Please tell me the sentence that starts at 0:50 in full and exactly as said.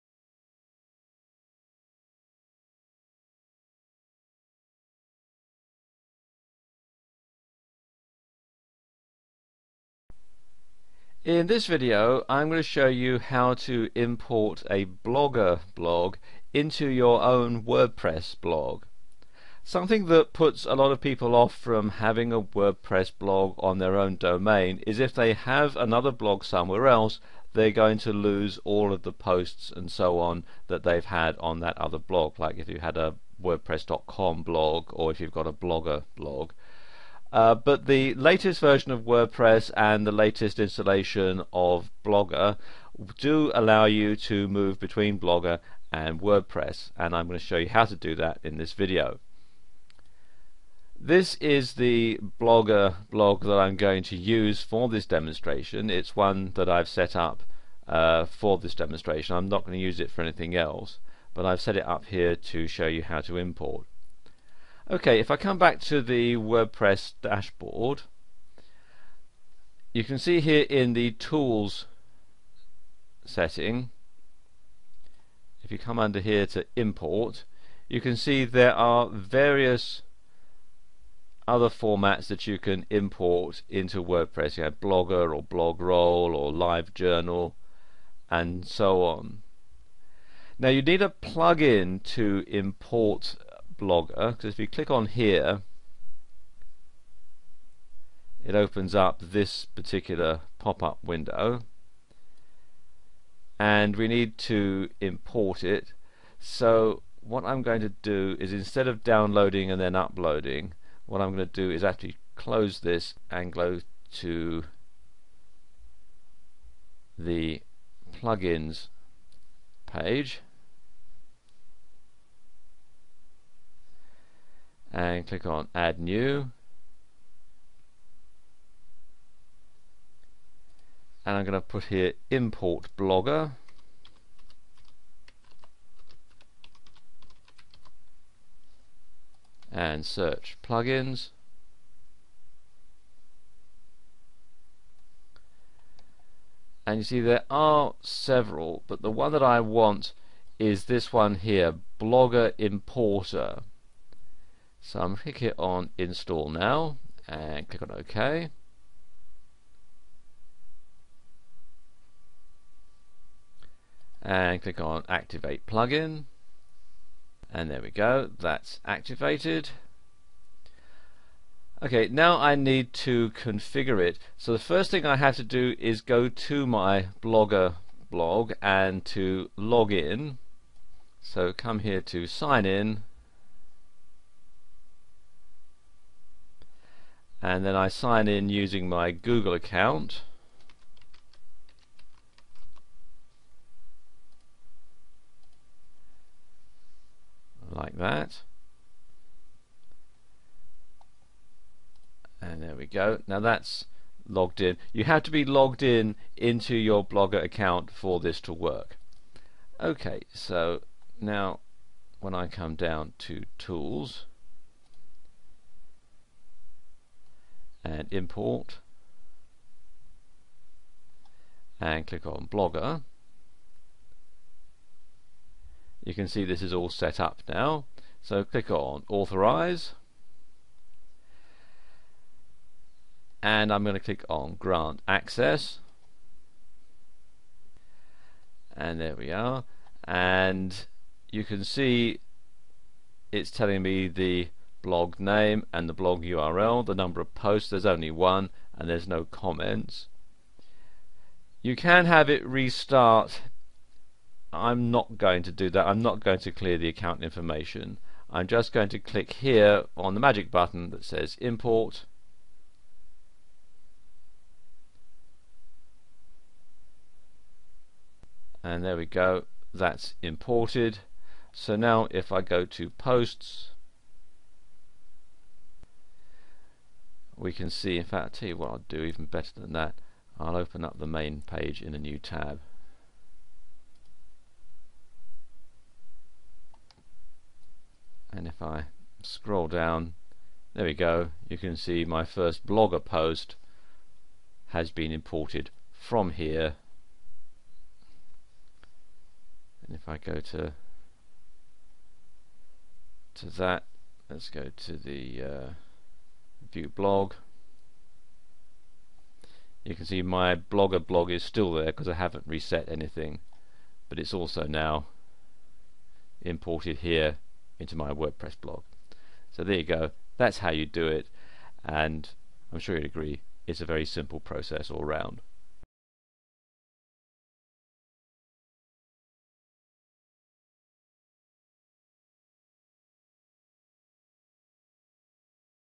This is the Blogger blog that I'm going to use for this demonstration.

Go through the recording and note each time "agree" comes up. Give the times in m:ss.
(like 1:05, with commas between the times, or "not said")
5:23.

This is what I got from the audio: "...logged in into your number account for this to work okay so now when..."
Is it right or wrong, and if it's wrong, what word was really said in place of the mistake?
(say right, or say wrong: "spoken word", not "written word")
wrong: "blogger", not "number".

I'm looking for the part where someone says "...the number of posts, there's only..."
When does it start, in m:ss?
4:06.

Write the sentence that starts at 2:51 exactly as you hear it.
Okay, now I need to configure it.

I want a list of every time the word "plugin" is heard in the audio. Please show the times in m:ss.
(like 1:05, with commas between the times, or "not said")
1:31, 1:58, 2:20, 2:45.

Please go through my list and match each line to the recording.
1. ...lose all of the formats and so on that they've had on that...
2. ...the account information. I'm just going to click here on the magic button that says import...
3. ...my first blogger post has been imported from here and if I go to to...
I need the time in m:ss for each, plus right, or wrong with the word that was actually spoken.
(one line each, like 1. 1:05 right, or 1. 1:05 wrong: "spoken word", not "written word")
1. 0:28 wrong: "posts", not "formats"
2. 4:16 right
3. 4:52 right.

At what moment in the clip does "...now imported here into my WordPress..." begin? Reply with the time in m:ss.
5:14.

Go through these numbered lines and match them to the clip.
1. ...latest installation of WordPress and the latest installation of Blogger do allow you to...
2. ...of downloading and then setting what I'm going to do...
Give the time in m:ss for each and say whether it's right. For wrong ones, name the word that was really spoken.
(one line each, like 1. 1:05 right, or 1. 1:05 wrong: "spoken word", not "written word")
1. 0:38 wrong: "version", not "installation"
2. 1:48 wrong: "uploading", not "setting".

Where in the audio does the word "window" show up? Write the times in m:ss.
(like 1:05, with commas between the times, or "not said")
1:41.